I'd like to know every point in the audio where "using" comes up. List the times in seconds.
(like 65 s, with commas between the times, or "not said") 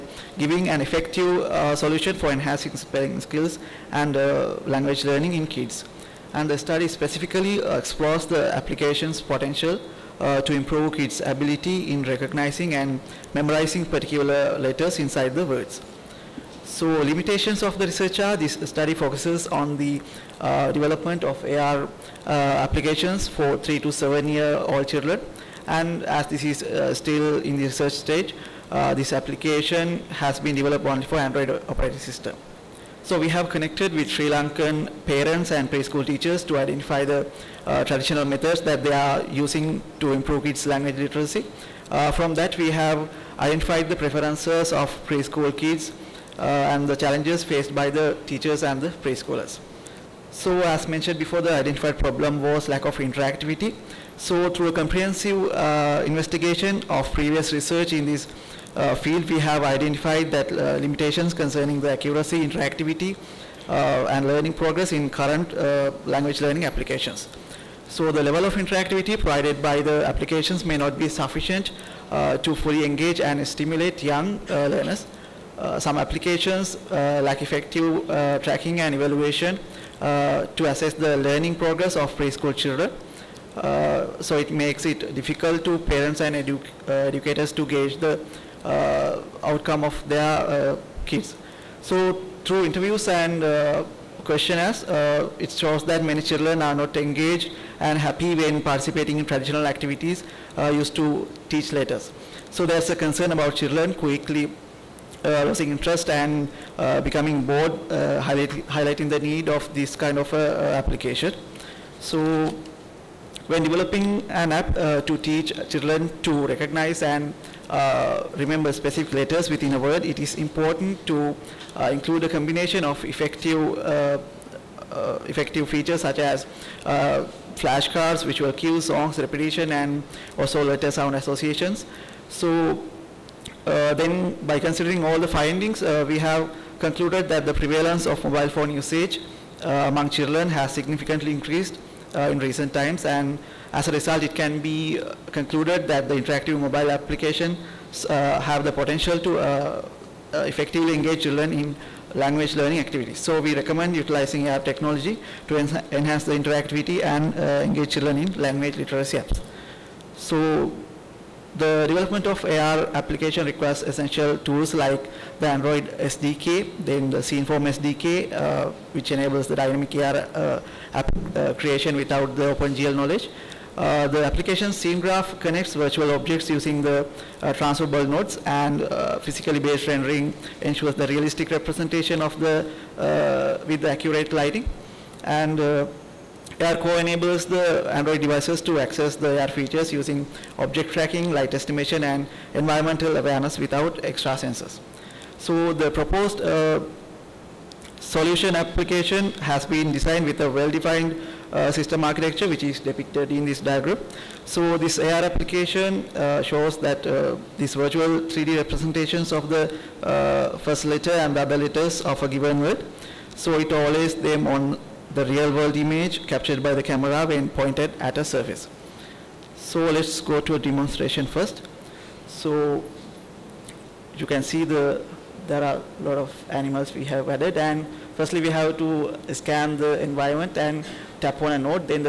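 39 s, 176 s, 189 s.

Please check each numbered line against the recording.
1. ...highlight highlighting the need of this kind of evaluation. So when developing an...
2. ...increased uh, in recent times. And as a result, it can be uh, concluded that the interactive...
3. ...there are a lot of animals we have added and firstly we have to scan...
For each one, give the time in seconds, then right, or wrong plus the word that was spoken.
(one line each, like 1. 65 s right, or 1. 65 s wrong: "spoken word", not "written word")
1. 107 s wrong: "application", not "evaluation"
2. 141 s right
3. 225 s right.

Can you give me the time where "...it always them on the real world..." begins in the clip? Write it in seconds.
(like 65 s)
213 s.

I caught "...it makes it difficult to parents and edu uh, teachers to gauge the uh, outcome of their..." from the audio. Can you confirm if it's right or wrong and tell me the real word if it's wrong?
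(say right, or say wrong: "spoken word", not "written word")
wrong: "educators", not "teachers".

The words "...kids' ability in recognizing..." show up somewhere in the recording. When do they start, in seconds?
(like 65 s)
10 s.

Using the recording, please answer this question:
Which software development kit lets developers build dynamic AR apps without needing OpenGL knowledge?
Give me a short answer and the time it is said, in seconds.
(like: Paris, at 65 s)
Sceneform SDK, at 167 s.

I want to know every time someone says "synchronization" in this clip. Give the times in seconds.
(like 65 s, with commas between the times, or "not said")
not said.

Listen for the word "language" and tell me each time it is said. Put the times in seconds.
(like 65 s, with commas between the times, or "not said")
4 s, 40 s, 66 s, 152 s, 158 s.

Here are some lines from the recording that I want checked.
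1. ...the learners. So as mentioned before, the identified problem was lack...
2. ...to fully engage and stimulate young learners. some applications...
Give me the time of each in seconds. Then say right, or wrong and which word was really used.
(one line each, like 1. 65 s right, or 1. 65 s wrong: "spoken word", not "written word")
1. 48 s wrong: "preschoolers", not "learners"
2. 72 s right.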